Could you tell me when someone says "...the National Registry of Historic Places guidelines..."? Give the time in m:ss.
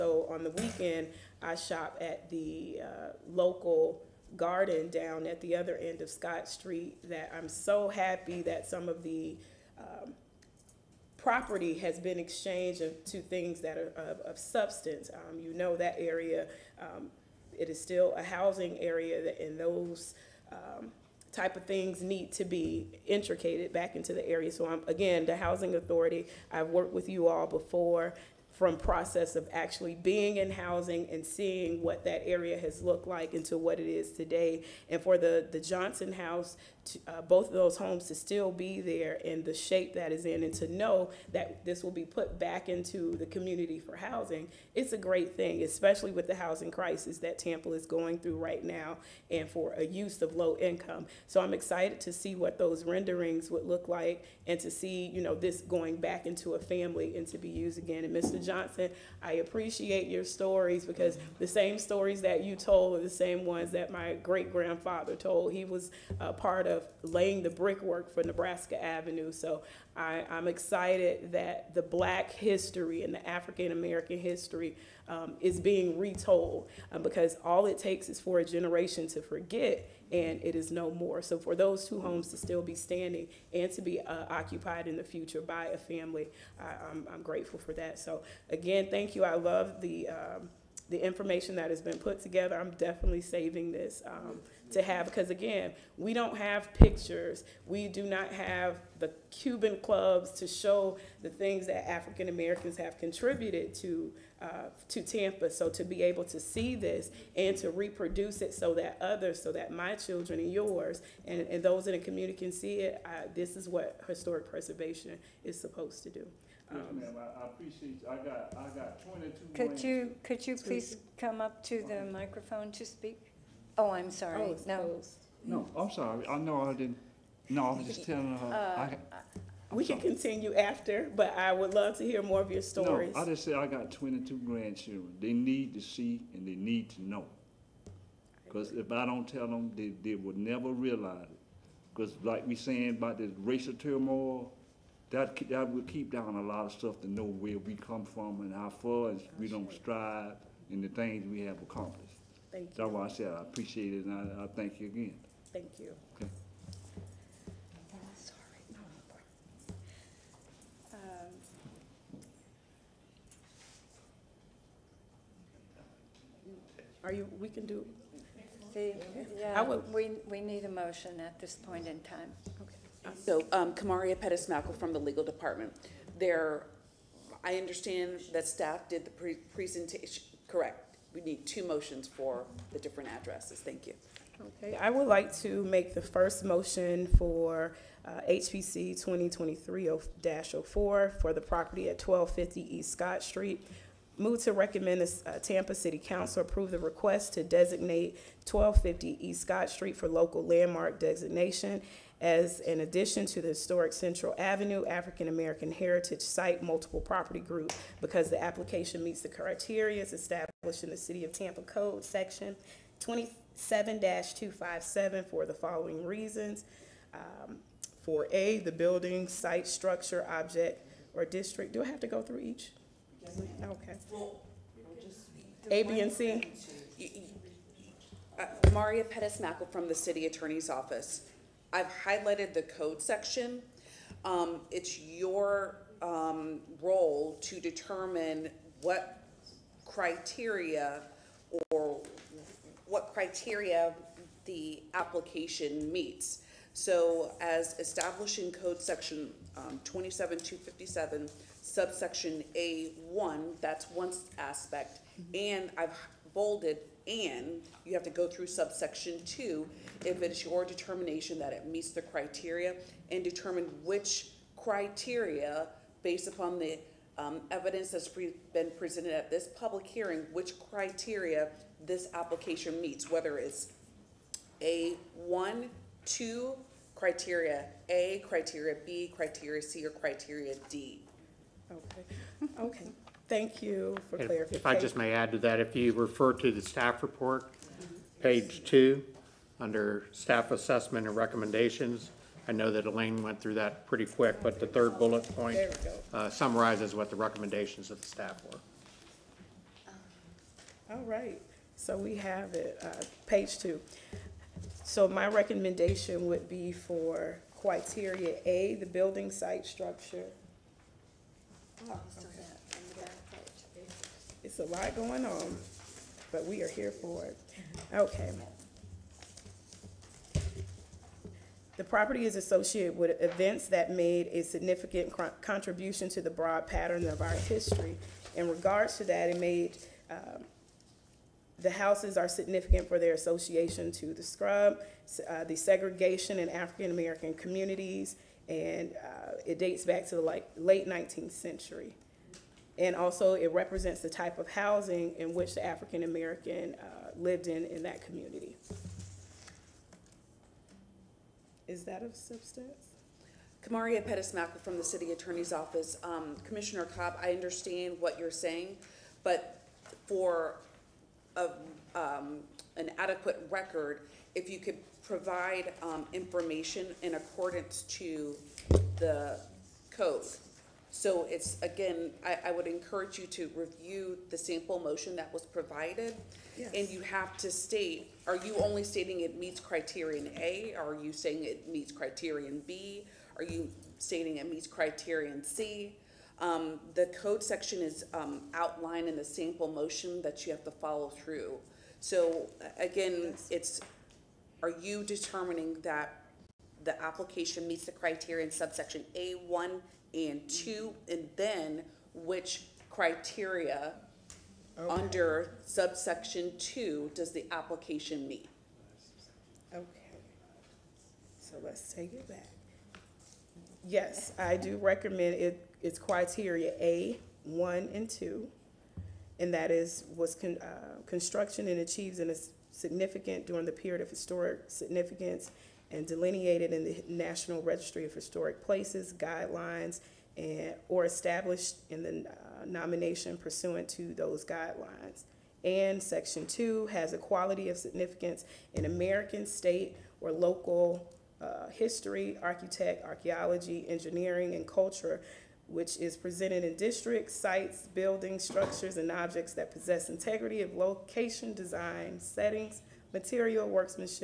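7:06.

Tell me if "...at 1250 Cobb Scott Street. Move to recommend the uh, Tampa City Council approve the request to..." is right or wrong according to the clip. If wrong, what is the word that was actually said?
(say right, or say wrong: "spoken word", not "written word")
wrong: "East", not "Cobb".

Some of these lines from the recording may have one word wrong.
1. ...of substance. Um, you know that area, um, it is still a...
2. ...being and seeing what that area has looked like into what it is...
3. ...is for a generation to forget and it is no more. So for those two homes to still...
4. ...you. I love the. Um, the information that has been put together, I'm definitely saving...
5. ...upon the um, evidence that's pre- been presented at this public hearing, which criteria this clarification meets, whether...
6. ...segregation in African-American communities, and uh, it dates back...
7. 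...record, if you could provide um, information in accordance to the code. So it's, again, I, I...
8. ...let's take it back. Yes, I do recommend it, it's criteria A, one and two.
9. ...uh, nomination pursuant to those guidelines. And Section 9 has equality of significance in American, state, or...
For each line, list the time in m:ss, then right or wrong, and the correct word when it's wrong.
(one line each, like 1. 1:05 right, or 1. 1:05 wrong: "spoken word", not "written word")
1. 0:14 right
2. 0:30 wrong: "housing", not "being"
3. 1:18 right
4. 1:29 right
5. 4:26 wrong: "application", not "clarification"
6. 5:35 right
7. 6:03 right
8. 6:51 right
9. 7:12 wrong: "2", not "9".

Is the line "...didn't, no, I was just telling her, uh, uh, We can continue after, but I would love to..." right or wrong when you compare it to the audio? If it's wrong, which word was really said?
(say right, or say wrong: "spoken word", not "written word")
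right.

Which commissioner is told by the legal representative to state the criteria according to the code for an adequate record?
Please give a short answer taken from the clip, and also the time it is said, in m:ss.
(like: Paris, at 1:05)
Commissioner Cobb, at 5:56.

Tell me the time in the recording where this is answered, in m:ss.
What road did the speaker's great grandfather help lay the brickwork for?
1:08.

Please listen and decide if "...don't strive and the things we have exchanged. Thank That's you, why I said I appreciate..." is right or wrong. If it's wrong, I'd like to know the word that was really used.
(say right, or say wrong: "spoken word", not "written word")
wrong: "accomplished", not "exchanged".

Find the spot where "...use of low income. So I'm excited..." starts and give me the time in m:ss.
0:49.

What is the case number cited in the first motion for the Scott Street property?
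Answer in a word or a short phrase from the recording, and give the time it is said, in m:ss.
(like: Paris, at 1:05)
HPC 2023-04, at 3:08.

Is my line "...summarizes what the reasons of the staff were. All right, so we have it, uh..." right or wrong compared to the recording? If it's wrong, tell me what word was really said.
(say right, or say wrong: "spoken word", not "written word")
wrong: "recommendations", not "reasons".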